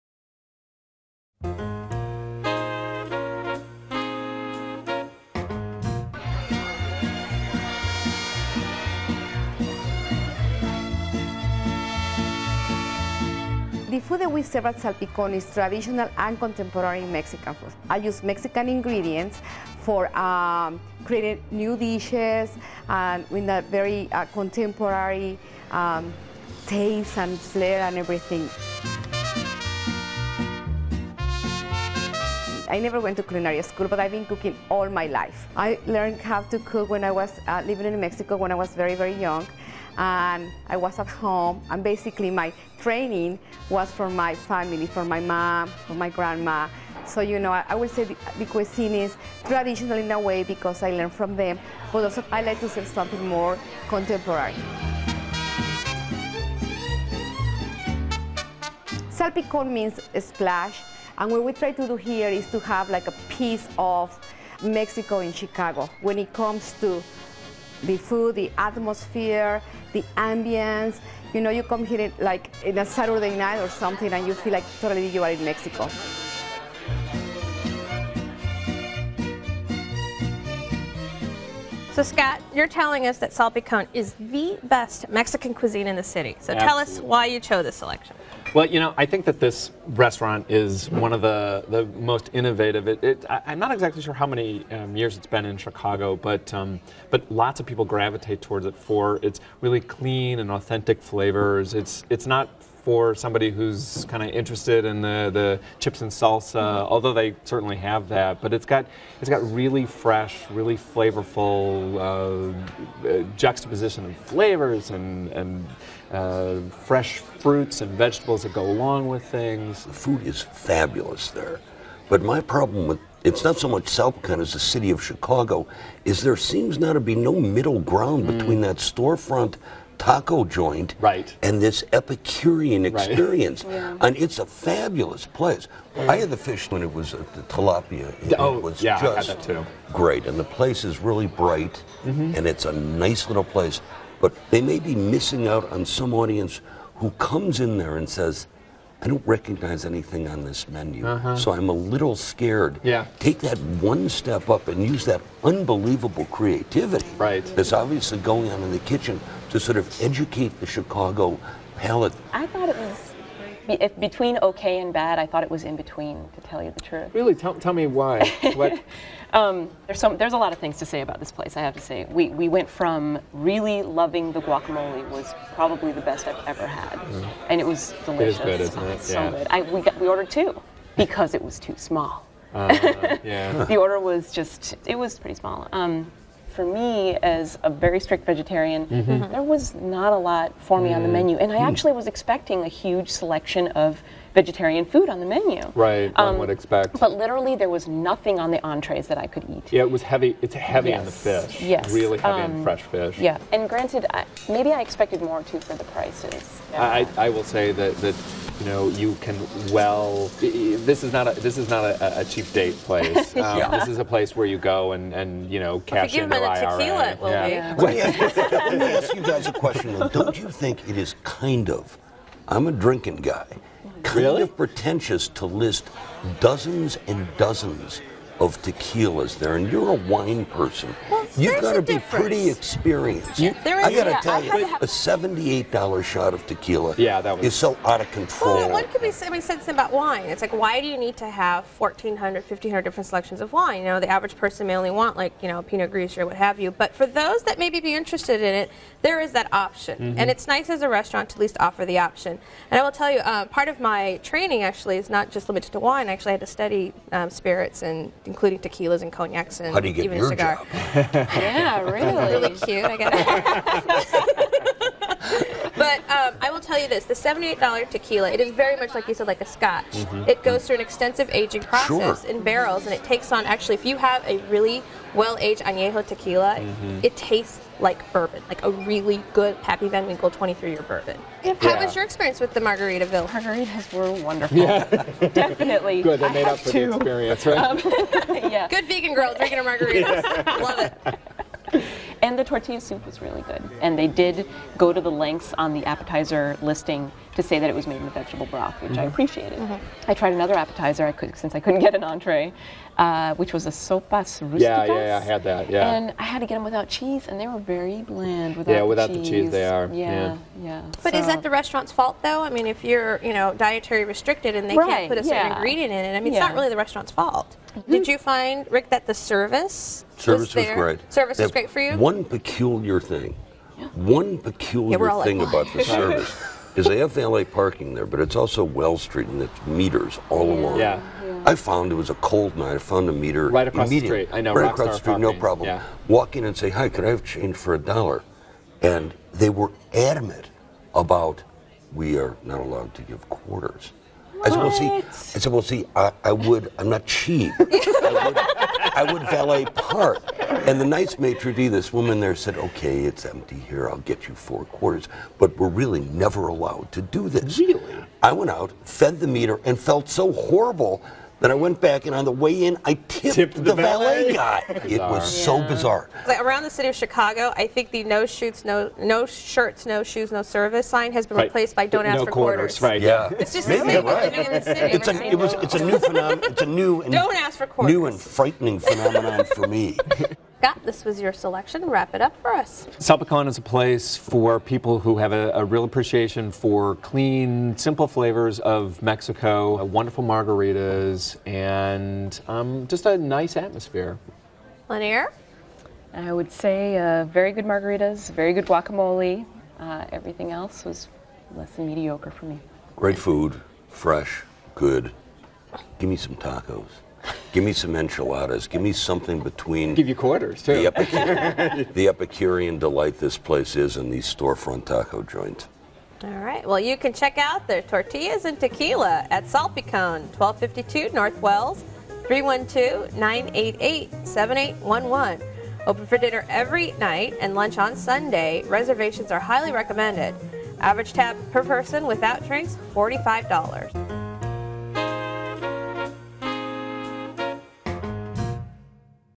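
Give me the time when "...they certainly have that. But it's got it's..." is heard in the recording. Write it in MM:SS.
01:47.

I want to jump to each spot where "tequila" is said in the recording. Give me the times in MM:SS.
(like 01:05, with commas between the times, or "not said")
03:36, 03:48, 03:56, 04:18, 04:27, 04:36, 06:58.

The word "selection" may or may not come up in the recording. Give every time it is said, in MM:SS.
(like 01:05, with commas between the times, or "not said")
01:27, 03:13, 04:03, 06:21.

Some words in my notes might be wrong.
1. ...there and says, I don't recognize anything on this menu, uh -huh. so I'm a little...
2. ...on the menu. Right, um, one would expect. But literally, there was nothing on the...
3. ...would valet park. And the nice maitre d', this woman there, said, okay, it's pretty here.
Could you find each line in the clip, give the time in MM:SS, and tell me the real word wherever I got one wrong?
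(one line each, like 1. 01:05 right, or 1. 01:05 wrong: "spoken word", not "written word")
1. 02:27 right
2. 03:15 right
3. 05:49 wrong: "empty", not "pretty".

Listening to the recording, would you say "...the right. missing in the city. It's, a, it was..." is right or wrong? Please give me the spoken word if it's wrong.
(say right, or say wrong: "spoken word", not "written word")
wrong: "living", not "missing".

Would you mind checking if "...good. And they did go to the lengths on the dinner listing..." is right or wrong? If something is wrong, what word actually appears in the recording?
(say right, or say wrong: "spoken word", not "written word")
wrong: "appetizer", not "dinner".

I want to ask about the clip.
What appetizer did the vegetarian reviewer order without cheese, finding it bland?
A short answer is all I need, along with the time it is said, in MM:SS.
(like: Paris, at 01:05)
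sopas rusticas, at 05:03.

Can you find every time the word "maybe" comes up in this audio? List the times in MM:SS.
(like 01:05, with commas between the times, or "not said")
03:24, 04:07, 06:13.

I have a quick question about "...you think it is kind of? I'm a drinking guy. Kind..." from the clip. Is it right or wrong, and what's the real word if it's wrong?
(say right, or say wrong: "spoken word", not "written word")
right.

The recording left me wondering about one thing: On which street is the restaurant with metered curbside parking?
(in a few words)
Wells Street.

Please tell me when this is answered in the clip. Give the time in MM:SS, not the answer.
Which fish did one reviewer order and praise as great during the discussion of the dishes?
02:17.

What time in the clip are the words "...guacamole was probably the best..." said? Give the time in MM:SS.
02:54.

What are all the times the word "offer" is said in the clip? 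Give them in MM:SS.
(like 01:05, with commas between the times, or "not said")
04:11.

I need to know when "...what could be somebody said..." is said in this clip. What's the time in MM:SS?
03:58.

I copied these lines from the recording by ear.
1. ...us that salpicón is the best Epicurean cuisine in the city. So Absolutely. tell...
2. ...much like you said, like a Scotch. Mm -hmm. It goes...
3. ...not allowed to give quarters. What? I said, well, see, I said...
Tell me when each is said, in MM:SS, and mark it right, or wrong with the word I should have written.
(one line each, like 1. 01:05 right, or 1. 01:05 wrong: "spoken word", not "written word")
1. 01:23 wrong: "Mexican", not "Epicurean"
2. 04:28 right
3. 05:42 right.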